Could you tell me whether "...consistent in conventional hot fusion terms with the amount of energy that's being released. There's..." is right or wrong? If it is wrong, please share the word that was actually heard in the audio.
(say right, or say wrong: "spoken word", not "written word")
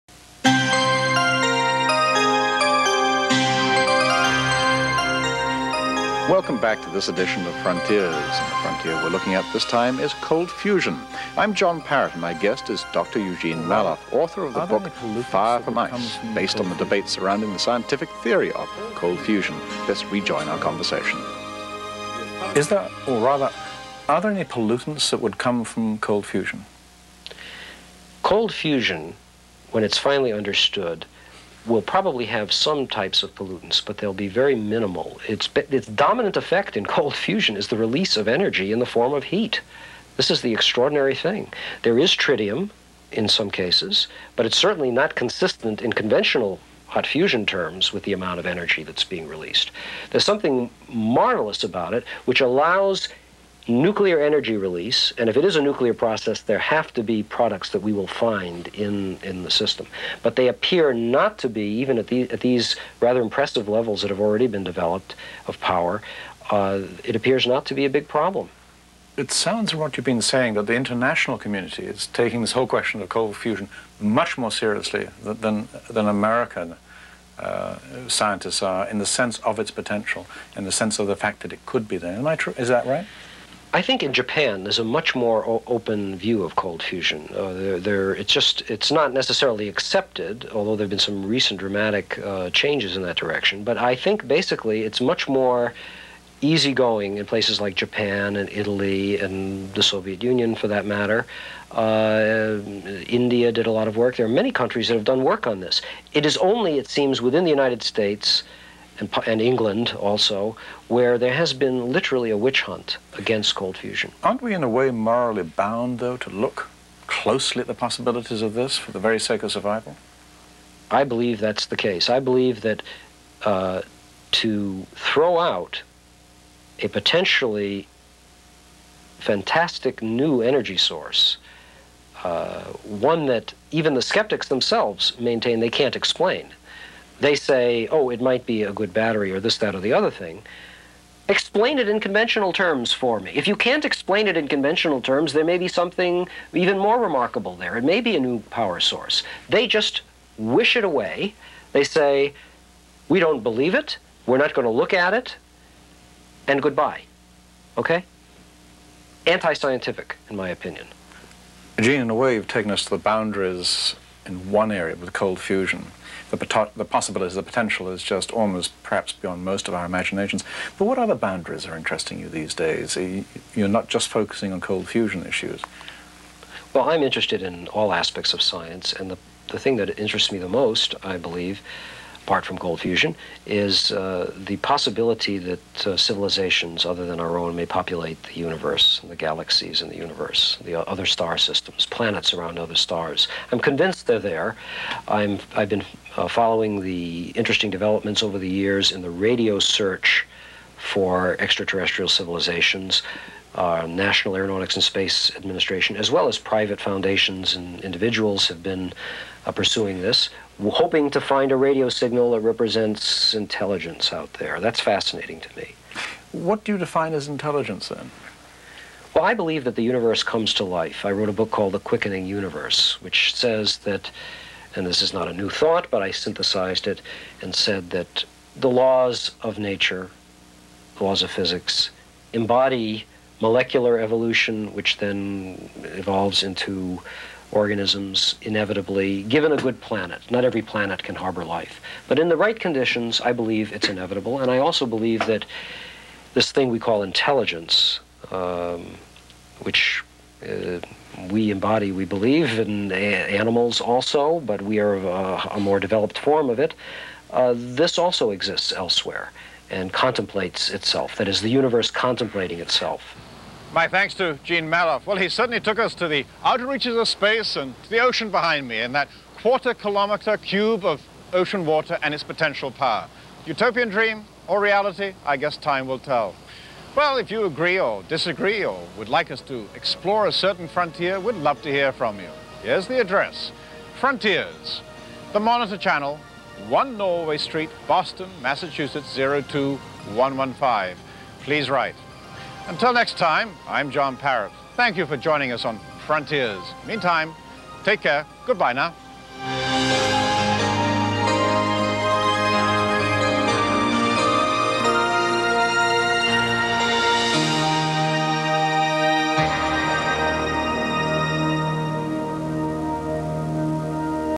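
right.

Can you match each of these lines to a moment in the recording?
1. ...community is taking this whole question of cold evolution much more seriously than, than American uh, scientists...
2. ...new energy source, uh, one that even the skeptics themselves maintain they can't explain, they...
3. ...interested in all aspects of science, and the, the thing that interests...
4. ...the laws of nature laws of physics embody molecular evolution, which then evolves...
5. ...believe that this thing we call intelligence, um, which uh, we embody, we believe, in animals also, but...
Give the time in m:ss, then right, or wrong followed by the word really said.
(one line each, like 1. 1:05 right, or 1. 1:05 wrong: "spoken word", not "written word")
1. 1:11 wrong: "fusion", not "evolution"
2. 2:10 right
3. 2:57 right
4. 3:48 right
5. 4:04 right.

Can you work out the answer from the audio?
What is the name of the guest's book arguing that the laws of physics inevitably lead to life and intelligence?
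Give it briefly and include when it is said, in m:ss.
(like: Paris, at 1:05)
The Quickening Universe, at 3:41.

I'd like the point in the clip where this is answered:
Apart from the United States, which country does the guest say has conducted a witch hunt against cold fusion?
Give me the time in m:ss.
1:49.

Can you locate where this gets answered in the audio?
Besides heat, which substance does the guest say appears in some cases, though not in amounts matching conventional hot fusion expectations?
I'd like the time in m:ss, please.
0:42.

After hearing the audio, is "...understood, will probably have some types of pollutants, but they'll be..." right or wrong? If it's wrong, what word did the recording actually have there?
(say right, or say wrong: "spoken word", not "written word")
right.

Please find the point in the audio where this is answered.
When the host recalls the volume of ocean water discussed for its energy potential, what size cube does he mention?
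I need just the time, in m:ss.
4:29.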